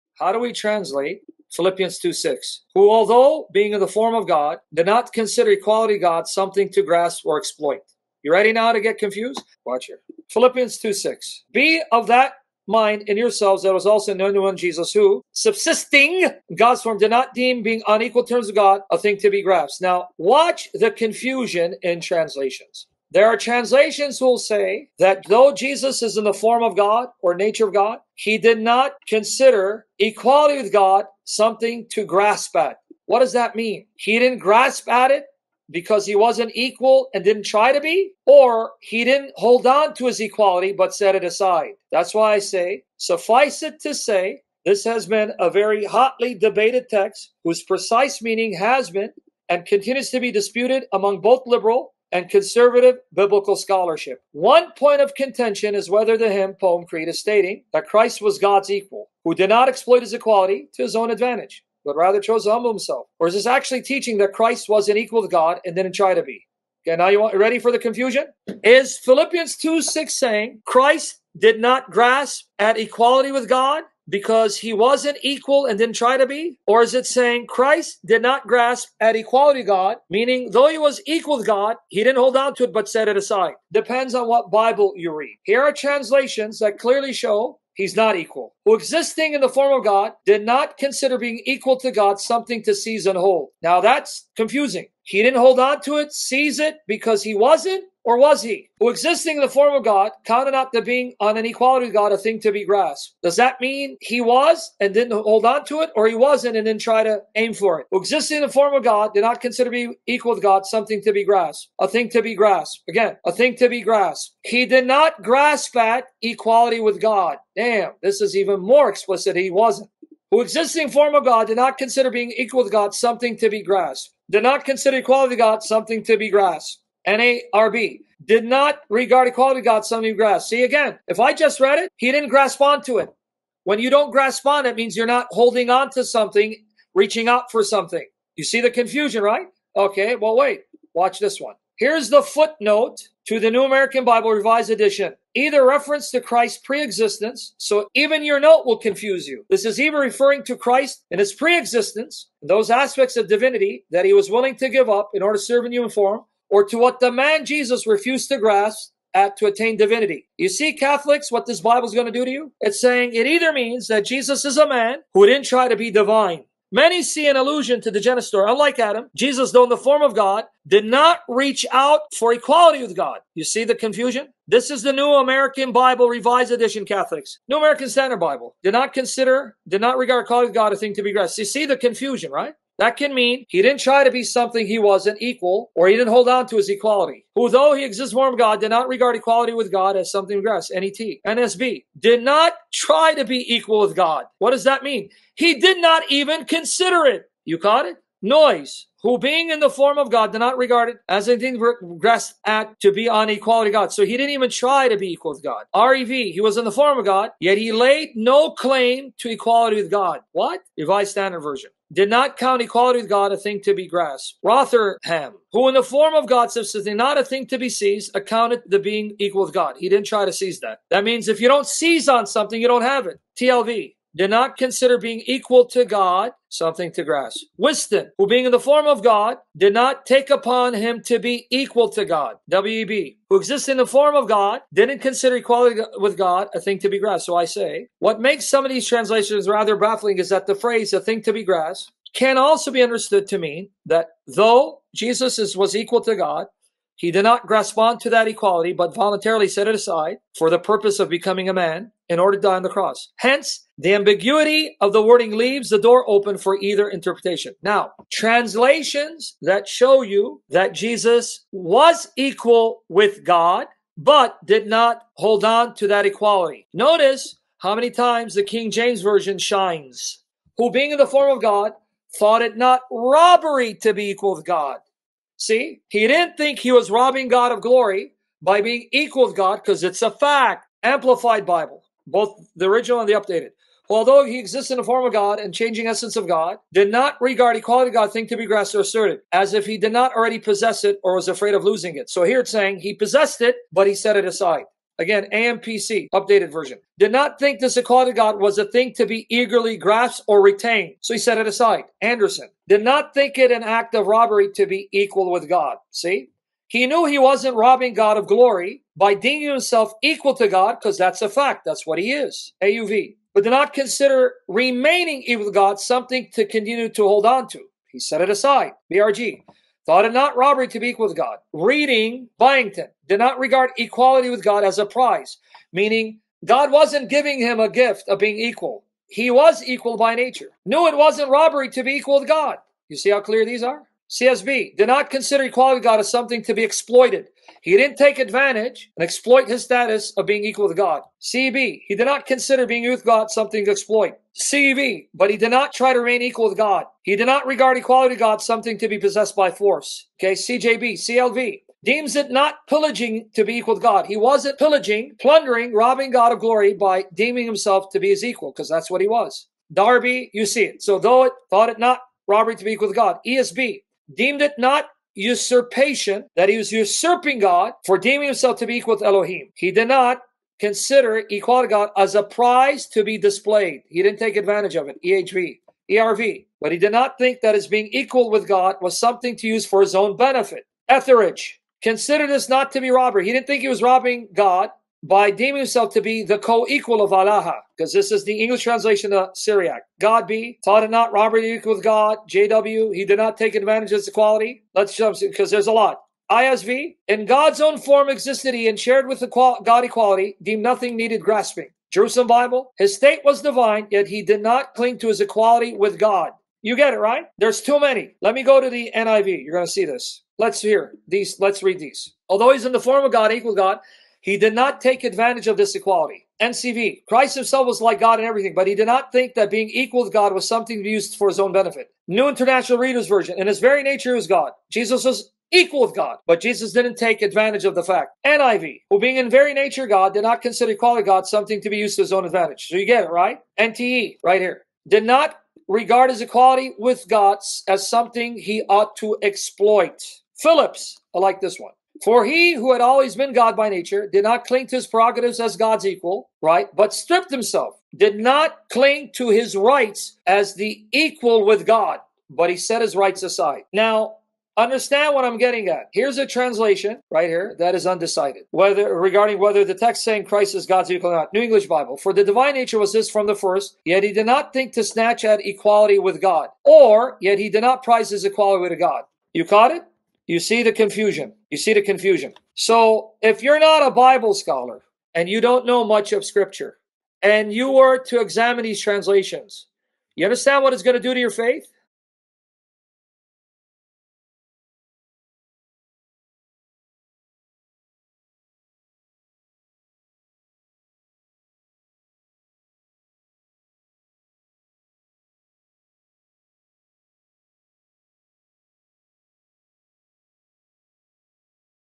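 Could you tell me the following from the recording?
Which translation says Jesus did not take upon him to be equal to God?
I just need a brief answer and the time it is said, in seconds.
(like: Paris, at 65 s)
Wisdom, at 227 s.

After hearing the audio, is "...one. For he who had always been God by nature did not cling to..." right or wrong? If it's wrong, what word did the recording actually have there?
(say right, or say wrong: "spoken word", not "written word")
right.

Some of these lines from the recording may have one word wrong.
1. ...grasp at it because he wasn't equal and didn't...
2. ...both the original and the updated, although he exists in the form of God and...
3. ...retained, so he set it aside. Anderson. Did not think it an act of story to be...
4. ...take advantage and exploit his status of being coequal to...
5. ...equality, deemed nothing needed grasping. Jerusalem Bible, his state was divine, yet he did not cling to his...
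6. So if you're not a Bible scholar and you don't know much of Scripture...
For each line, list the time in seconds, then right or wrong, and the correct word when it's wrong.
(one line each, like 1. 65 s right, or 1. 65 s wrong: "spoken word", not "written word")
1. 34 s right
2. 282 s right
3. 300 s wrong: "robbery", not "story"
4. 337 s wrong: "equal", not "coequal"
5. 399 s right
6. 472 s right.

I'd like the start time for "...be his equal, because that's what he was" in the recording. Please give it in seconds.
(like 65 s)
357 s.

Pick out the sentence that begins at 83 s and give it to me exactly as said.
Depends on what Bible you read.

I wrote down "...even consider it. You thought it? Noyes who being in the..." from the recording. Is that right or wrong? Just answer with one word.
wrong.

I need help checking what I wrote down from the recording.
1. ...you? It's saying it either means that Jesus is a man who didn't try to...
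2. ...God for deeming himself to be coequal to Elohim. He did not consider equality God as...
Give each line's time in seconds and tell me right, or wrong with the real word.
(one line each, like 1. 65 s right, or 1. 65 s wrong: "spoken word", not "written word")
1. 162 s right
2. 367 s wrong: "equal", not "coequal".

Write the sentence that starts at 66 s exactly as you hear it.
Okay, now you want, ready for the confusion?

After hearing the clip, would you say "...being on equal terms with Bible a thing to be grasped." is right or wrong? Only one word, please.
wrong.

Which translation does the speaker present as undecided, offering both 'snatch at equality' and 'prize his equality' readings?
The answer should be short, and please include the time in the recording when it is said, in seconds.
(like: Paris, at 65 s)
New English Bible, at 461 s.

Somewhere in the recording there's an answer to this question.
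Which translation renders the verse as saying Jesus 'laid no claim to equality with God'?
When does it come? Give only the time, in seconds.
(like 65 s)
205 s.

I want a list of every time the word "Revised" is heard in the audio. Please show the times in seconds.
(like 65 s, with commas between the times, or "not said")
144 s, 176 s, 210 s.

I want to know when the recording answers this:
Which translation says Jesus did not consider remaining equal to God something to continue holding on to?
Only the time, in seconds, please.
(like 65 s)
312 s.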